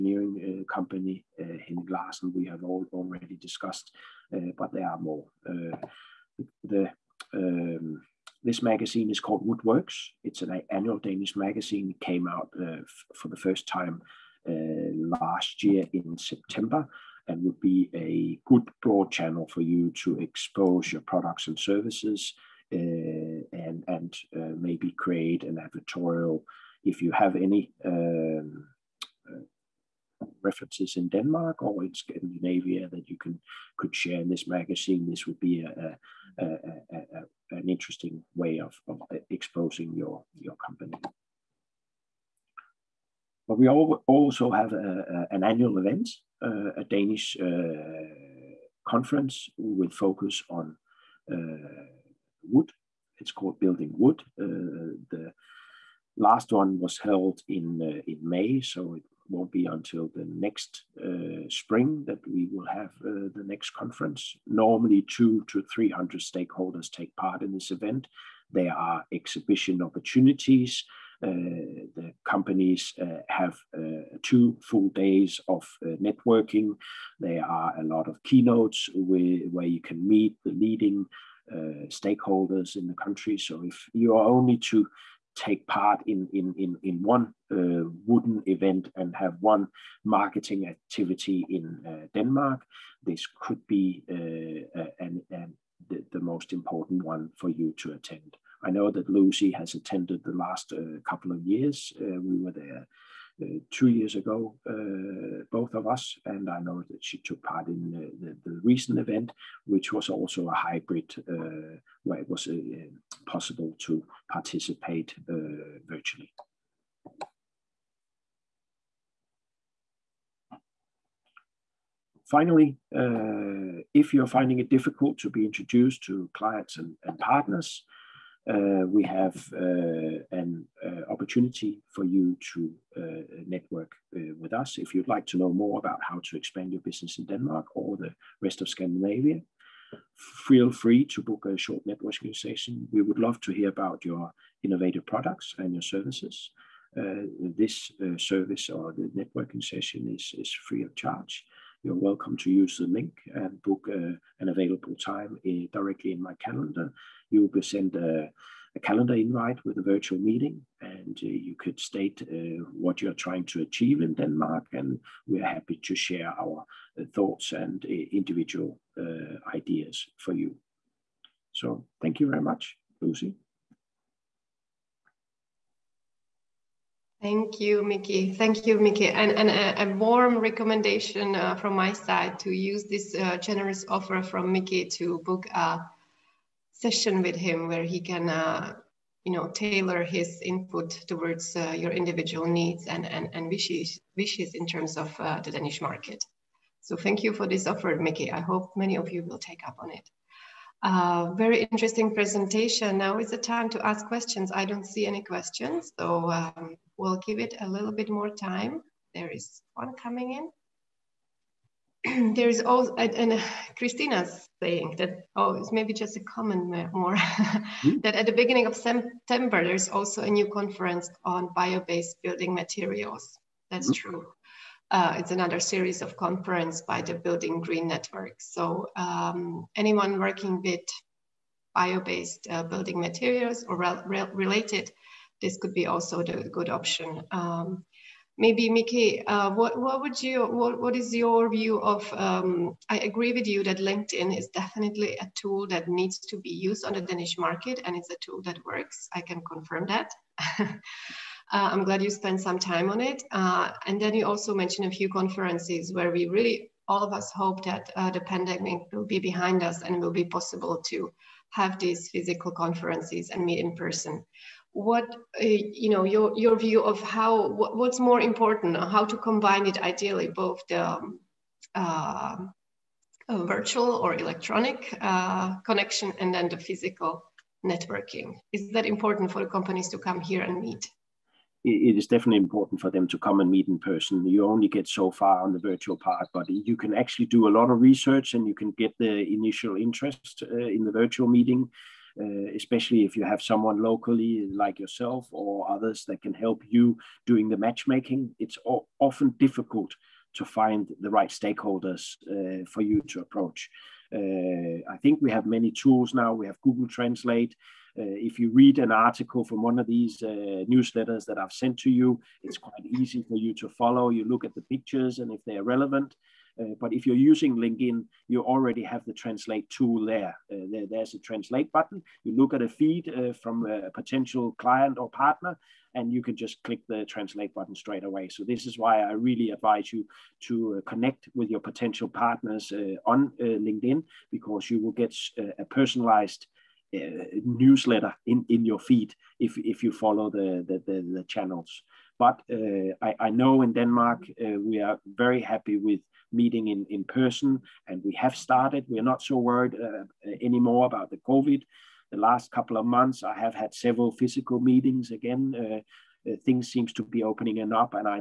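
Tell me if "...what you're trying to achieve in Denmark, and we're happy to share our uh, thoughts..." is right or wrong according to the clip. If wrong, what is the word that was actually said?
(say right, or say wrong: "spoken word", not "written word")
right.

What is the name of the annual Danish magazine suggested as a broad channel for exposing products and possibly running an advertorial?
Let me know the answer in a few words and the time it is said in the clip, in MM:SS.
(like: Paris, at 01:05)
Woodworks, at 00:09.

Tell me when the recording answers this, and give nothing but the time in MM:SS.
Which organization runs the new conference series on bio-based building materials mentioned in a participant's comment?
03:47.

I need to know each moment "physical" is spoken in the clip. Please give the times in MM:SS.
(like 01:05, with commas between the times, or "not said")
04:22, 04:36, 05:54.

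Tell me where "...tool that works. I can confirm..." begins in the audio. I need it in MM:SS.
04:08.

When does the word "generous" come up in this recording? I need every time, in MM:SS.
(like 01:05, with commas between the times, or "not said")
03:03.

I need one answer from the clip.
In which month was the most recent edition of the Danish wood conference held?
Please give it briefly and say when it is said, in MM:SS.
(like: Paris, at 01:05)
May, at 00:58.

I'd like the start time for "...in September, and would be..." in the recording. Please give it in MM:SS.
00:15.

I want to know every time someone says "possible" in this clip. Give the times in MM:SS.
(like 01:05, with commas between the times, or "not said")
01:53, 04:20.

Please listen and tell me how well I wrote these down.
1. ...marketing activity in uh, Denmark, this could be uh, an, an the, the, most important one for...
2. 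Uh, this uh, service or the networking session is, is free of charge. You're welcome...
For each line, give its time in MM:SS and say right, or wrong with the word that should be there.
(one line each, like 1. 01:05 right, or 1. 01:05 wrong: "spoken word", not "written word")
1. 01:30 right
2. 02:26 right.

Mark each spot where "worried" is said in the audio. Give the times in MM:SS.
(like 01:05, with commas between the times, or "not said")
05:49.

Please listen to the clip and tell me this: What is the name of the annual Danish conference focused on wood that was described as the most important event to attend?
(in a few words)
Building Wood.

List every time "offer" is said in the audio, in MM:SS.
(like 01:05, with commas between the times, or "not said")
03:03, 03:17.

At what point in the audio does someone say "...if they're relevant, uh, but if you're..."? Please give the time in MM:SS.
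05:15.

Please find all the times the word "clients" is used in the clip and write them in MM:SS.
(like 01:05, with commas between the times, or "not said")
02:06, 05:24.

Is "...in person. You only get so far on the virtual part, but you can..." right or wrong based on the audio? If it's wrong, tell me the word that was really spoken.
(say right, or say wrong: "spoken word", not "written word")
right.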